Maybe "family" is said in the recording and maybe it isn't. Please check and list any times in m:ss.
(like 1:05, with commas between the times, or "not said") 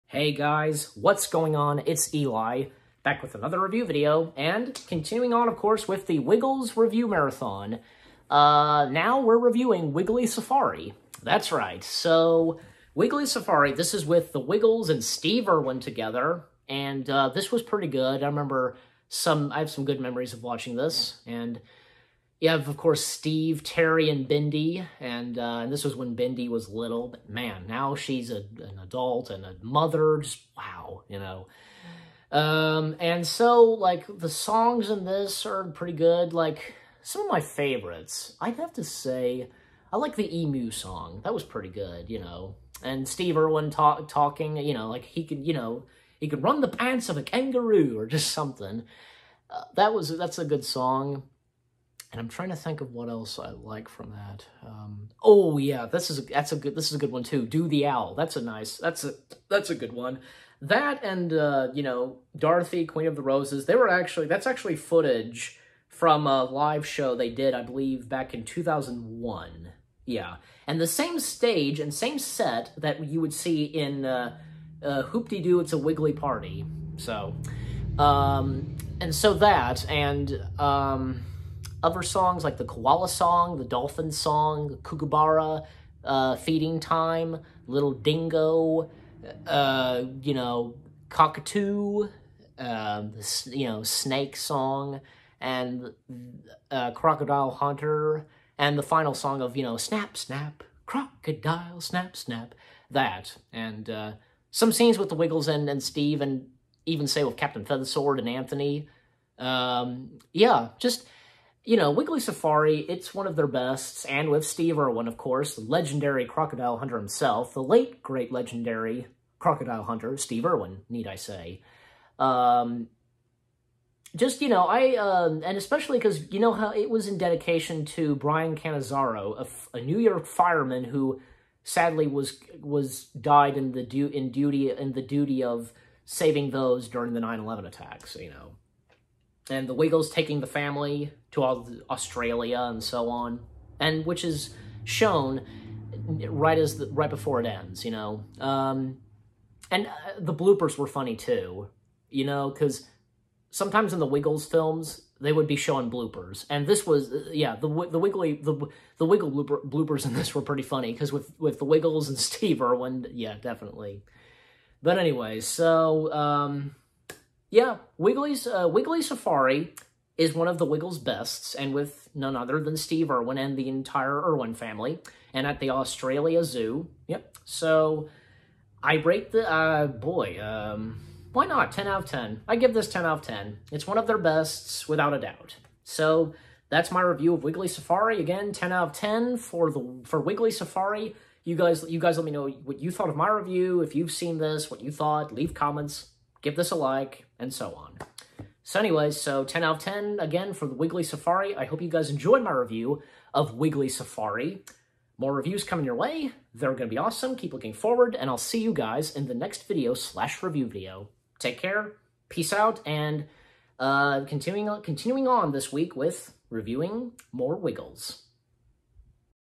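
2:20, 2:54.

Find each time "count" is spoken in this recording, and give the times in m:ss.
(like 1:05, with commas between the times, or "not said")
not said.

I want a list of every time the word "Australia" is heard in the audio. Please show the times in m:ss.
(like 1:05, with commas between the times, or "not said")
2:21, 2:55.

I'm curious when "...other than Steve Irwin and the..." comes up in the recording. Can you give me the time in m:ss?
2:52.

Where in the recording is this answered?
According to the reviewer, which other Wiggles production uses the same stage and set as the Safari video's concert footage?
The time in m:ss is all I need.
1:15.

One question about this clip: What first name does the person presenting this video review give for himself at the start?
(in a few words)
Eli.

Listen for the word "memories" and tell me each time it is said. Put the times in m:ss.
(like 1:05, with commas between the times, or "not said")
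0:20.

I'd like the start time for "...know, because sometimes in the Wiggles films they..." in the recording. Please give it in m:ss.
2:32.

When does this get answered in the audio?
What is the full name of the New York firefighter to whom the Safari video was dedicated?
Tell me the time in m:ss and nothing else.
2:08.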